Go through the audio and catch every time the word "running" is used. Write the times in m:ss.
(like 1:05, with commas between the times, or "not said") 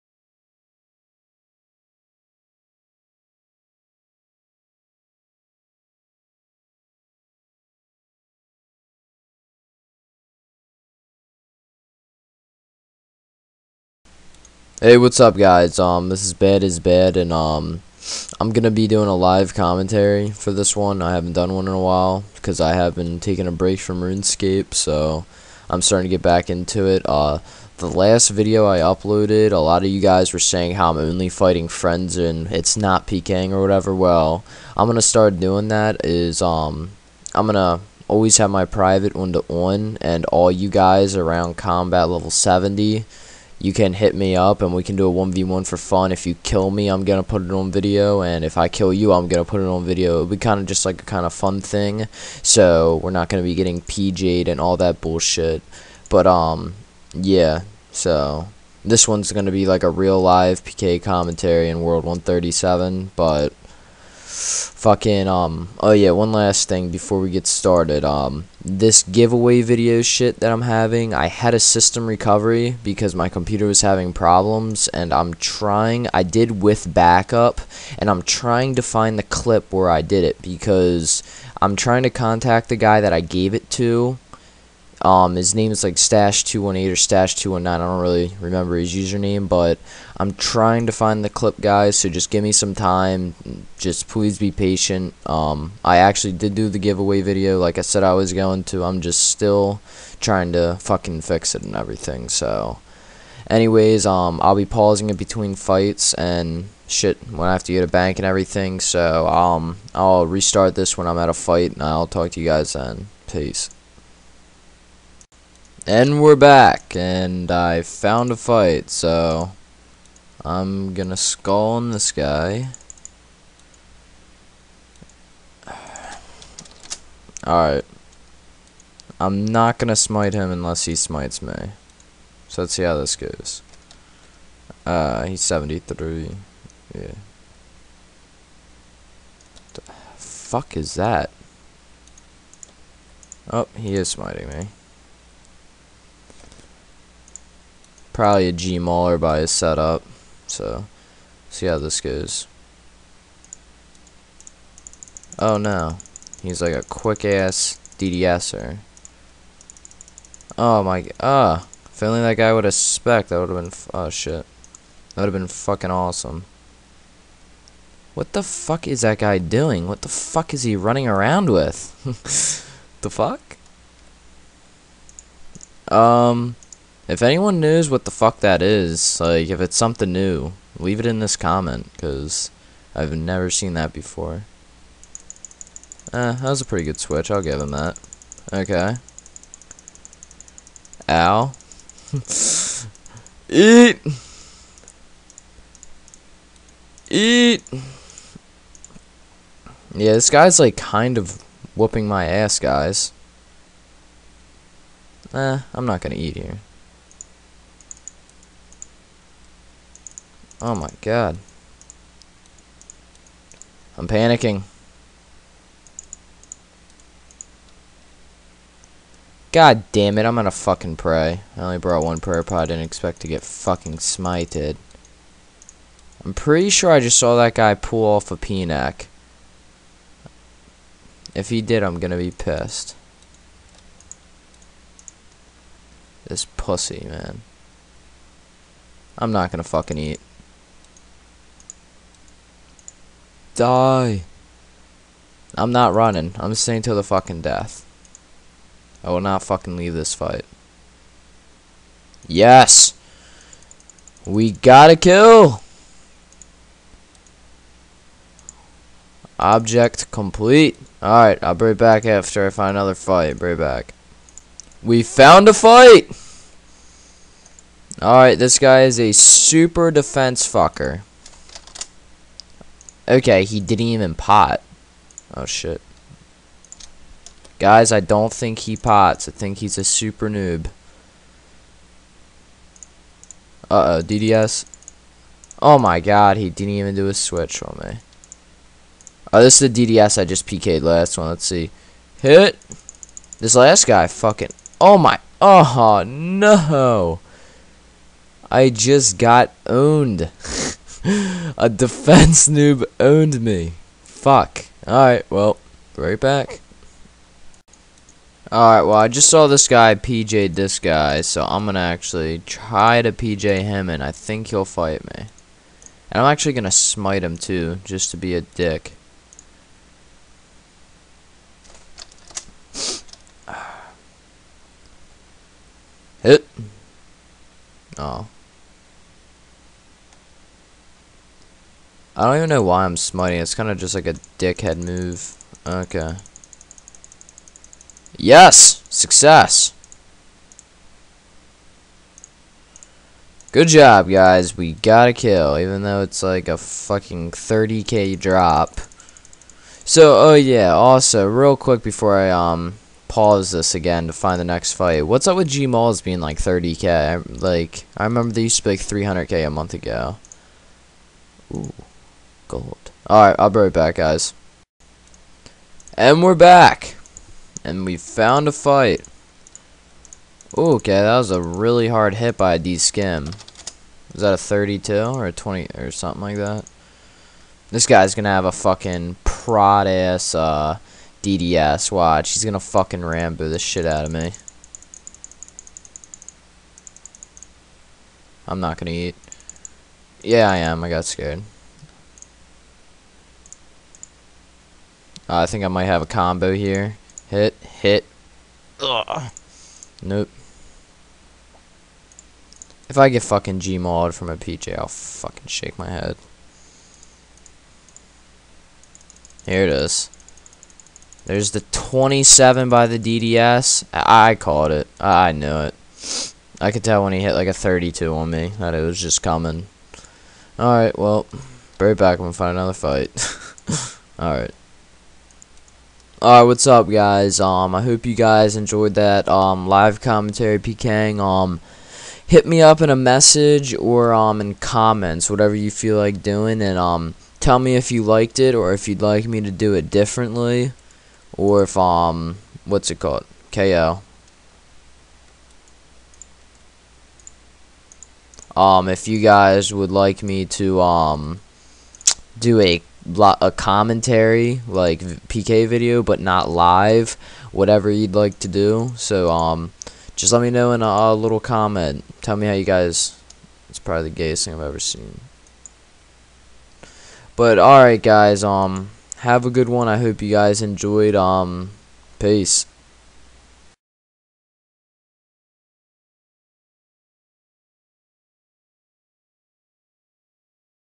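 2:50, 4:05.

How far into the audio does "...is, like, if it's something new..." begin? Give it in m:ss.
2:58.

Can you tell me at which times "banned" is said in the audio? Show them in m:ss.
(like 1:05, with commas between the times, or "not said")
not said.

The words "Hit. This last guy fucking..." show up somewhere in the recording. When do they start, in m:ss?
4:52.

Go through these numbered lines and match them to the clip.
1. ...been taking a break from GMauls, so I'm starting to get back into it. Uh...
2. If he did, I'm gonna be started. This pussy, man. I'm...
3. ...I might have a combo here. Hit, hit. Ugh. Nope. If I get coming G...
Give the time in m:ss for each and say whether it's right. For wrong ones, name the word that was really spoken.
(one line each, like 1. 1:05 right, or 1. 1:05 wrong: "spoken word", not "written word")
1. 0:22 wrong: "RuneScape", not "GMauls"
2. 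3:51 wrong: "pissed", not "started"
3. 6:35 wrong: "fucking", not "coming".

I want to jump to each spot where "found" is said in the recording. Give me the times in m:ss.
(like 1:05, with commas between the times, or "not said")
1:57, 4:25, 6:07.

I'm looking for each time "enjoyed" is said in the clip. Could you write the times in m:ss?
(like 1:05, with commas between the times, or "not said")
7:08, 7:50.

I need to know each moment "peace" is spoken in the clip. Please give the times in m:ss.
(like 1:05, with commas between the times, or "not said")
1:53, 7:52.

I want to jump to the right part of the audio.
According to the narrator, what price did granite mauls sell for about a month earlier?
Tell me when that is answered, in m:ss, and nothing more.
5:58.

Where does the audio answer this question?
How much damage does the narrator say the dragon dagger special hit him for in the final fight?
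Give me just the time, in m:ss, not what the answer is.
6:51.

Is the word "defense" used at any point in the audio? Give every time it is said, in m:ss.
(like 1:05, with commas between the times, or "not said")
4:29, 5:01.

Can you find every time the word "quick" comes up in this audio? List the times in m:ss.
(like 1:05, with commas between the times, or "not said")
2:36, 5:51.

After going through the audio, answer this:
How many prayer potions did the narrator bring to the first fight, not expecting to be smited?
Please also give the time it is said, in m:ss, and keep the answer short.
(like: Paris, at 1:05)
1, at 3:42.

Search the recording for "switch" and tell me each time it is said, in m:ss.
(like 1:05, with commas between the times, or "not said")
3:07, 4:47.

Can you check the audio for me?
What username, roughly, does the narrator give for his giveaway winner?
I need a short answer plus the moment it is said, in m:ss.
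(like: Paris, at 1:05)
Stash218, at 1:25.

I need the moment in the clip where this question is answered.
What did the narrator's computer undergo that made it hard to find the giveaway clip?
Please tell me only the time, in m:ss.
1:11.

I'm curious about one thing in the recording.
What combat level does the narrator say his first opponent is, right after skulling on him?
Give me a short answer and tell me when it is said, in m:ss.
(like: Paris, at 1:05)
73, at 2:15.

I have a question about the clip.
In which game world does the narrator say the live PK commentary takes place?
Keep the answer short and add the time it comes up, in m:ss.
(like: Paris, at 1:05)
137, at 1:01.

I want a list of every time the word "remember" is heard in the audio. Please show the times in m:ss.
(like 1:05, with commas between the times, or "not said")
1:28, 5:58.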